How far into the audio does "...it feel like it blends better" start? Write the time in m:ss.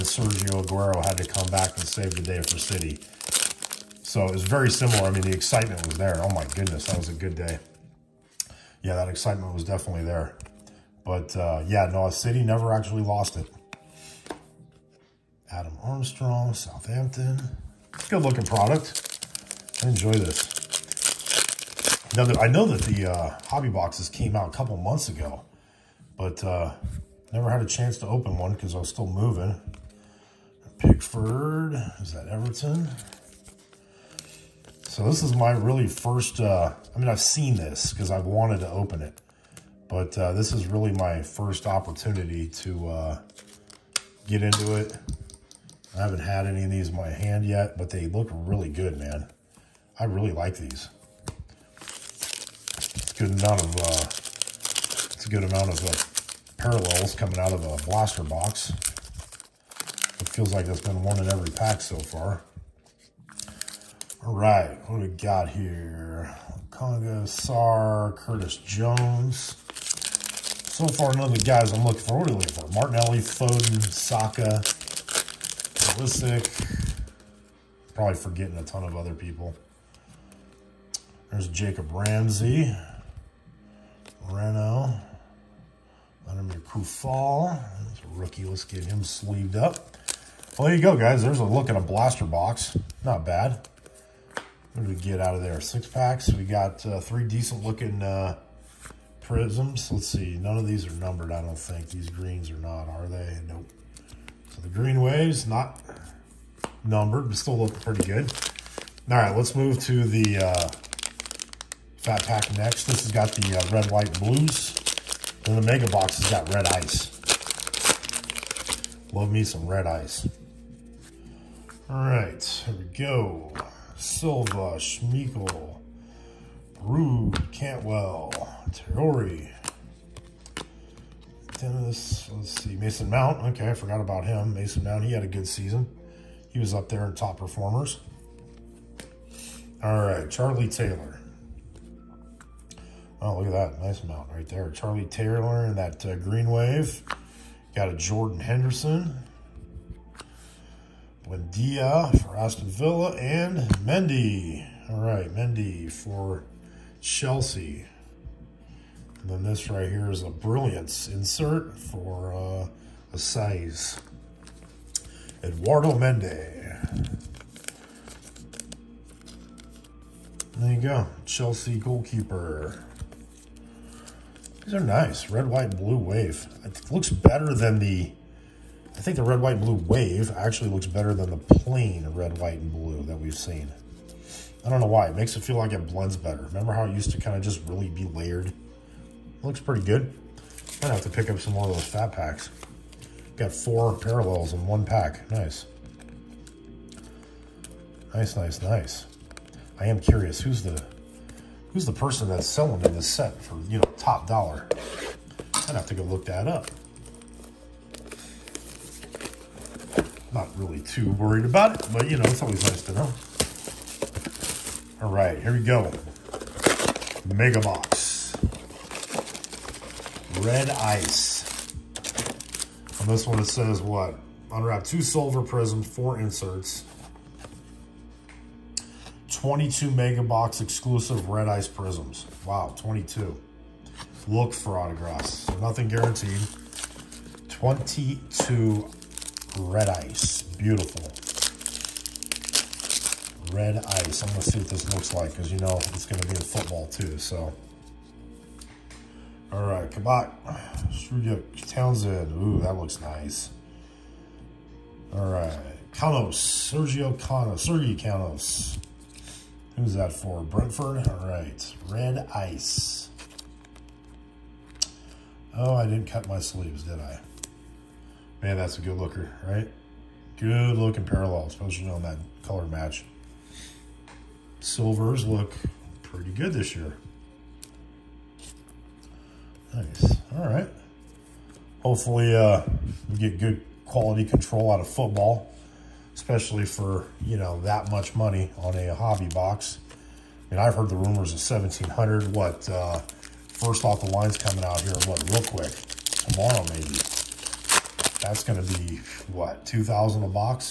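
3:05.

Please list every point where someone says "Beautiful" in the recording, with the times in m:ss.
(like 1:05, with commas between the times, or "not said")
4:00.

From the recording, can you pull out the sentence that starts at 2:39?
And then this right here is a brilliance insert for uh, a size.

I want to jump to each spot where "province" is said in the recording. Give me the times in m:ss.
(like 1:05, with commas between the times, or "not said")
not said.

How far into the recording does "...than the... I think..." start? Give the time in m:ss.
2:57.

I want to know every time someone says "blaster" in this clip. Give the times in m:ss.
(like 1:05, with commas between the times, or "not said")
0:57, 1:31.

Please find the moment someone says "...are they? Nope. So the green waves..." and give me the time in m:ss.
1:42.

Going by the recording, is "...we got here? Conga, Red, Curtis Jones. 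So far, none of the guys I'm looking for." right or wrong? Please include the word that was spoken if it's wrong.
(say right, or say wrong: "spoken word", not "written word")
wrong: "Sar", not "Red".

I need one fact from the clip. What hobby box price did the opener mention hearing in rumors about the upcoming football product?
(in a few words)
1700.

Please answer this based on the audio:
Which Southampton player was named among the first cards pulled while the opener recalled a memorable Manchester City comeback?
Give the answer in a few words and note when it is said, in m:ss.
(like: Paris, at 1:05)
Adam Armstrong, at 0:15.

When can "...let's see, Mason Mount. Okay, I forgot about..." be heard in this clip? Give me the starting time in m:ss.
2:12.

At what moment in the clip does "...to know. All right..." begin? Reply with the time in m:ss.
3:32.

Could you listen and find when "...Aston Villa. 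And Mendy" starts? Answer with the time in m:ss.
2:32.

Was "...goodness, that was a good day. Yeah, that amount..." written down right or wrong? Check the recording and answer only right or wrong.
wrong.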